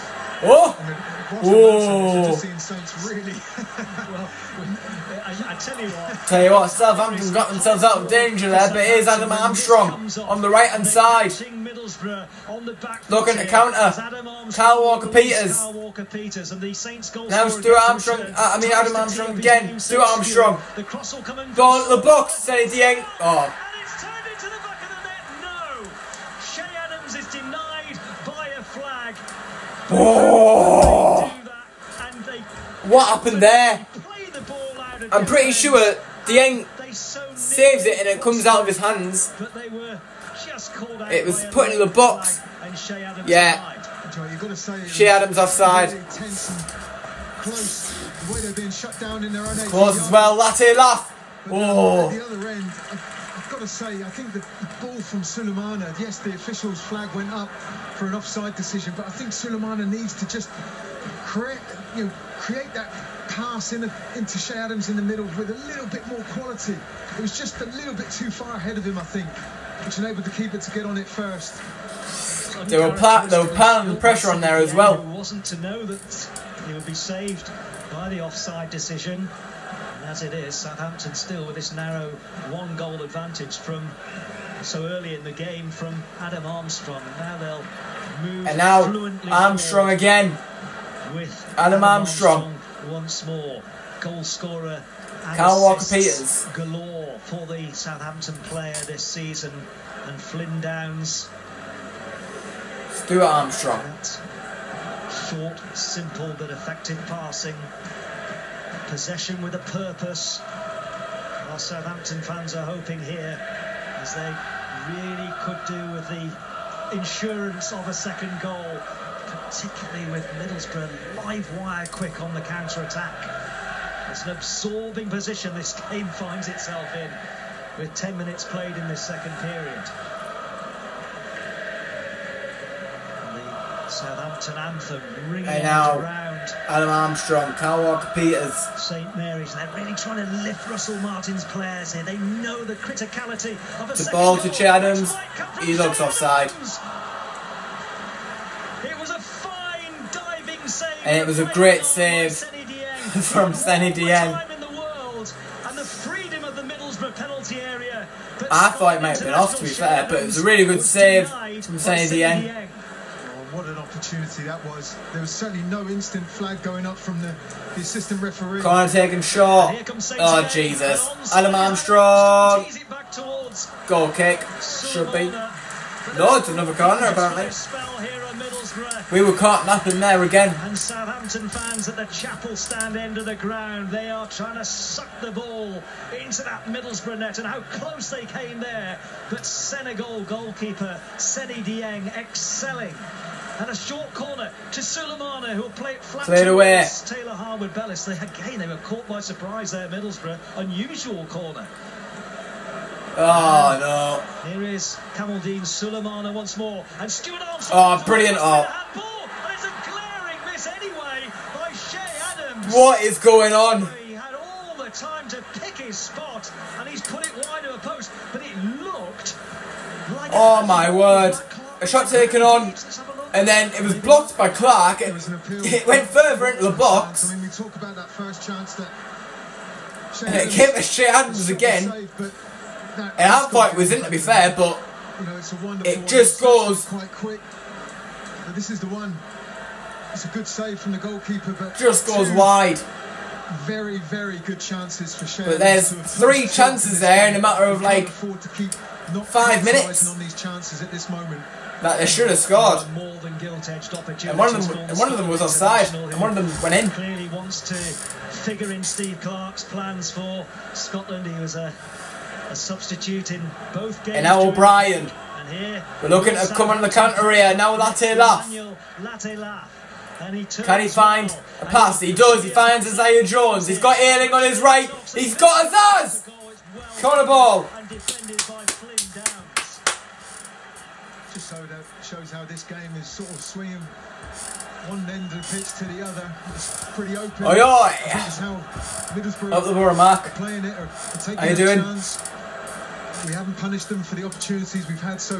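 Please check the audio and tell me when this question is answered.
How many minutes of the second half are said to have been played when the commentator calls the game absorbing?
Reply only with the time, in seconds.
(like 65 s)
127 s.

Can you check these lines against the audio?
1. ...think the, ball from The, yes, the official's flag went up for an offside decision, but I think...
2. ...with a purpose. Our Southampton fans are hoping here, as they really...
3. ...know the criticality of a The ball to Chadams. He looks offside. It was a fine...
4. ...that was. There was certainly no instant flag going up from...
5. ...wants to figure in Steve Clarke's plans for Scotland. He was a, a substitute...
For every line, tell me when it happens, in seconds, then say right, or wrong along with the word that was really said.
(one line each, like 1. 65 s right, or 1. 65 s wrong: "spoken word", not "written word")
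1. 54 s wrong: "Sulemana", not "The"
2. 109 s right
3. 142 s right
4. 164 s right
5. 257 s right.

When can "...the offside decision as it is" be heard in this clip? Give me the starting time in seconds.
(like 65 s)
78 s.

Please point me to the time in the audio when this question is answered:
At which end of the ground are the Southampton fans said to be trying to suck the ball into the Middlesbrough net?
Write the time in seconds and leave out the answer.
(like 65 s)
182 s.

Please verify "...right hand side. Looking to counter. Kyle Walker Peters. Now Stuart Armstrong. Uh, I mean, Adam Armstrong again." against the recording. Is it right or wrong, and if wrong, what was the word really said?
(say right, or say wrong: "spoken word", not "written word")
right.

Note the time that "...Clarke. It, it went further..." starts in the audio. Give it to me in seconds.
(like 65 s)
224 s.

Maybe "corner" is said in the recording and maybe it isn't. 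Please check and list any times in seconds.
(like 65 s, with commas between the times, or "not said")
176 s, 194 s, 201 s, 277 s.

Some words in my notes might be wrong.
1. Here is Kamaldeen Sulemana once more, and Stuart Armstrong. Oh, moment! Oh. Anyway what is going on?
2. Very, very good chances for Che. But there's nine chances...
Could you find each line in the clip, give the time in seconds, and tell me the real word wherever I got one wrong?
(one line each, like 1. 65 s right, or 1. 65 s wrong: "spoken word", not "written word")
1. 204 s wrong: "brilliant", not "moment"
2. 243 s wrong: "three", not "nine".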